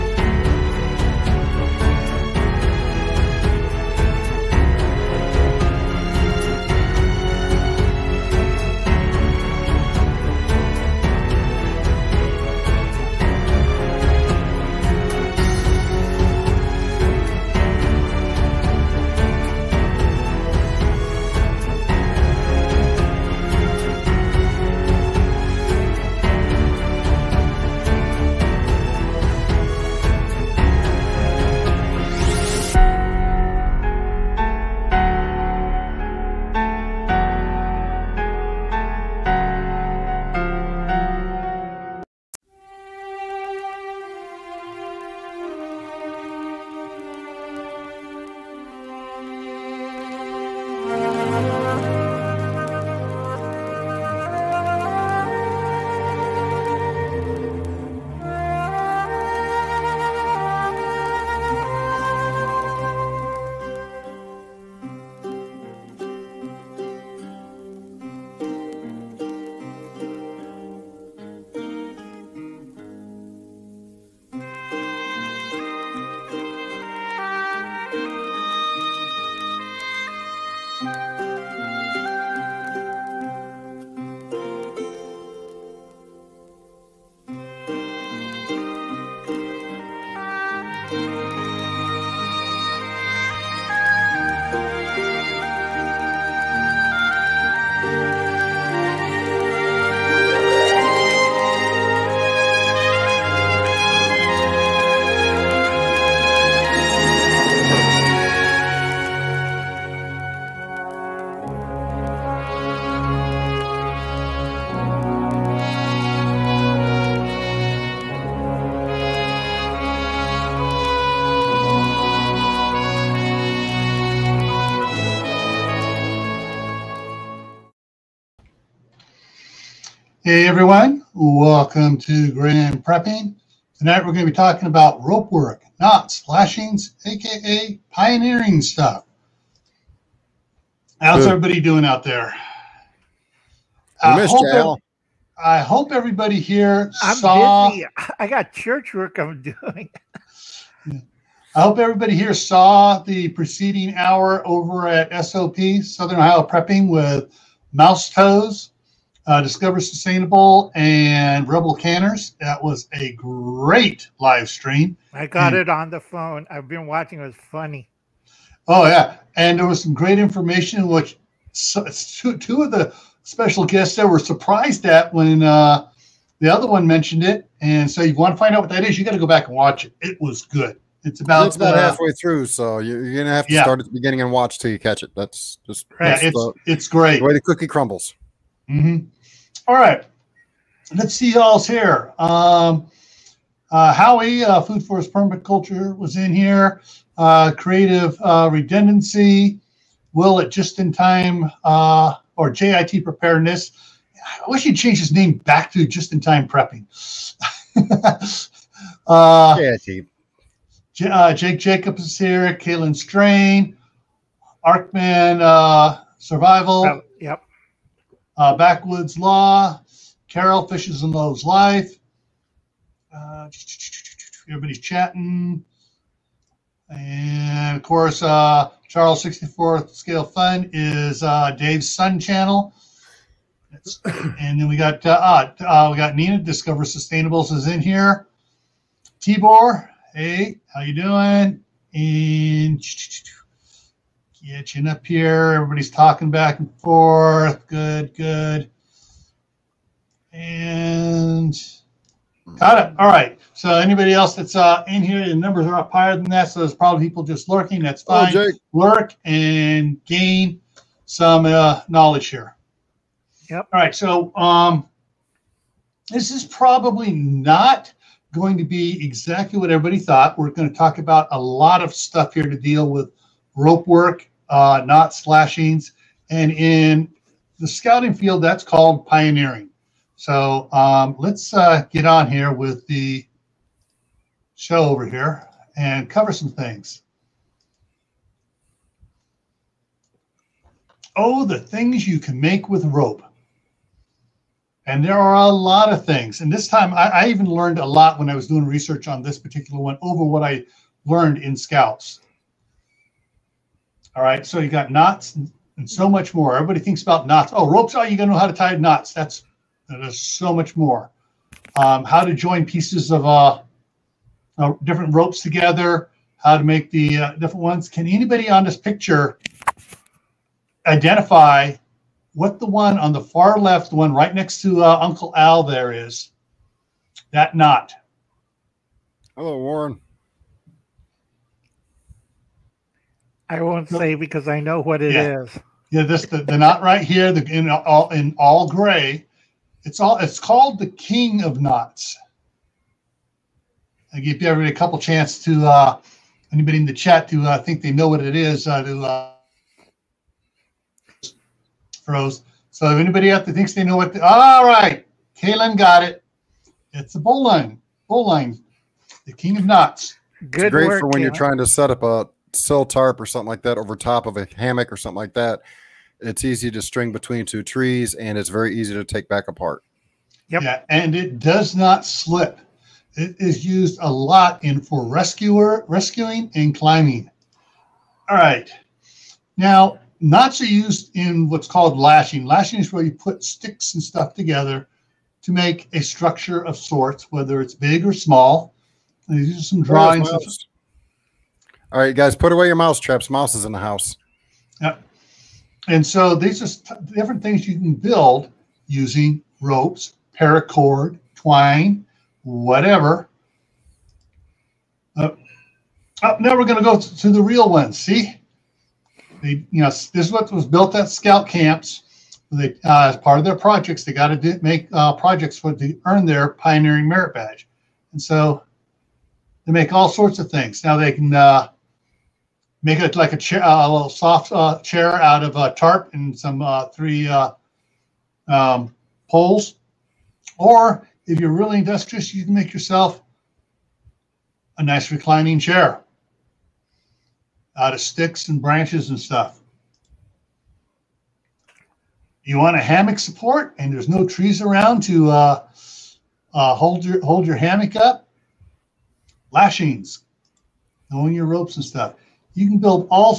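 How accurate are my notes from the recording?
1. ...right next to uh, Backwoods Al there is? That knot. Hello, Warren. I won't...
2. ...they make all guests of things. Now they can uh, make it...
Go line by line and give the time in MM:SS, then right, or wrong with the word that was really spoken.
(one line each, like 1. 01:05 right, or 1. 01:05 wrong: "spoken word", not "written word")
1. 05:24 wrong: "Uncle", not "Backwoods"
2. 06:59 wrong: "sorts", not "guests".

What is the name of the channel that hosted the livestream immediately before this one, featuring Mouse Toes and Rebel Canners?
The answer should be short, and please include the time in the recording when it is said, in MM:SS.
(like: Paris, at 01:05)
Southern Ohio Prepping, at 02:35.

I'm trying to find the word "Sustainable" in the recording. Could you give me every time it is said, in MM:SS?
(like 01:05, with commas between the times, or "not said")
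02:39, 03:56.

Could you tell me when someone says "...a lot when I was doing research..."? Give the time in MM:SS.
04:57.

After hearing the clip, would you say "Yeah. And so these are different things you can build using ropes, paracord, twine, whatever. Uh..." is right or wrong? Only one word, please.
right.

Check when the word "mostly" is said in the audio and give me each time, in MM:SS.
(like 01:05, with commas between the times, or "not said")
not said.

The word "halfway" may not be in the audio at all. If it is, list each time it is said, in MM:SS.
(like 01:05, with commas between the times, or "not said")
03:01.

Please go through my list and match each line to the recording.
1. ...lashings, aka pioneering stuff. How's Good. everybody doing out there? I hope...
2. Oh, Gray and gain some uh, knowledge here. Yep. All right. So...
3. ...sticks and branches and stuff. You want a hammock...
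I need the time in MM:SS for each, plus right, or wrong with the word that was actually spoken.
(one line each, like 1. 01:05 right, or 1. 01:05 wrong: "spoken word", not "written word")
1. 02:16 right
2. 04:18 wrong: "Lurk", not "Gray"
3. 07:18 right.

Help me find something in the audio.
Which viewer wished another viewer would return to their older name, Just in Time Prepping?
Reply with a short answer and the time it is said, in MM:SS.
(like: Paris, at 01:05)
JIT Preparedness, at 03:22.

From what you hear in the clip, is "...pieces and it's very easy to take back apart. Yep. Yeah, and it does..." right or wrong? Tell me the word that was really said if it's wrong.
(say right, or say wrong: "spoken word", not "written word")
wrong: "trees", not "pieces".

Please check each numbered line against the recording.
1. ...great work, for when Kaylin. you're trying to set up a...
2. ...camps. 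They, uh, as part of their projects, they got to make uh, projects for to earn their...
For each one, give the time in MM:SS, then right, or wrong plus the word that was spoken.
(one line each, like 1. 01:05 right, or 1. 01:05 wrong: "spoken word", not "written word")
1. 06:00 right
2. 06:51 right.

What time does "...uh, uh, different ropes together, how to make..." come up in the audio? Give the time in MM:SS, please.
05:13.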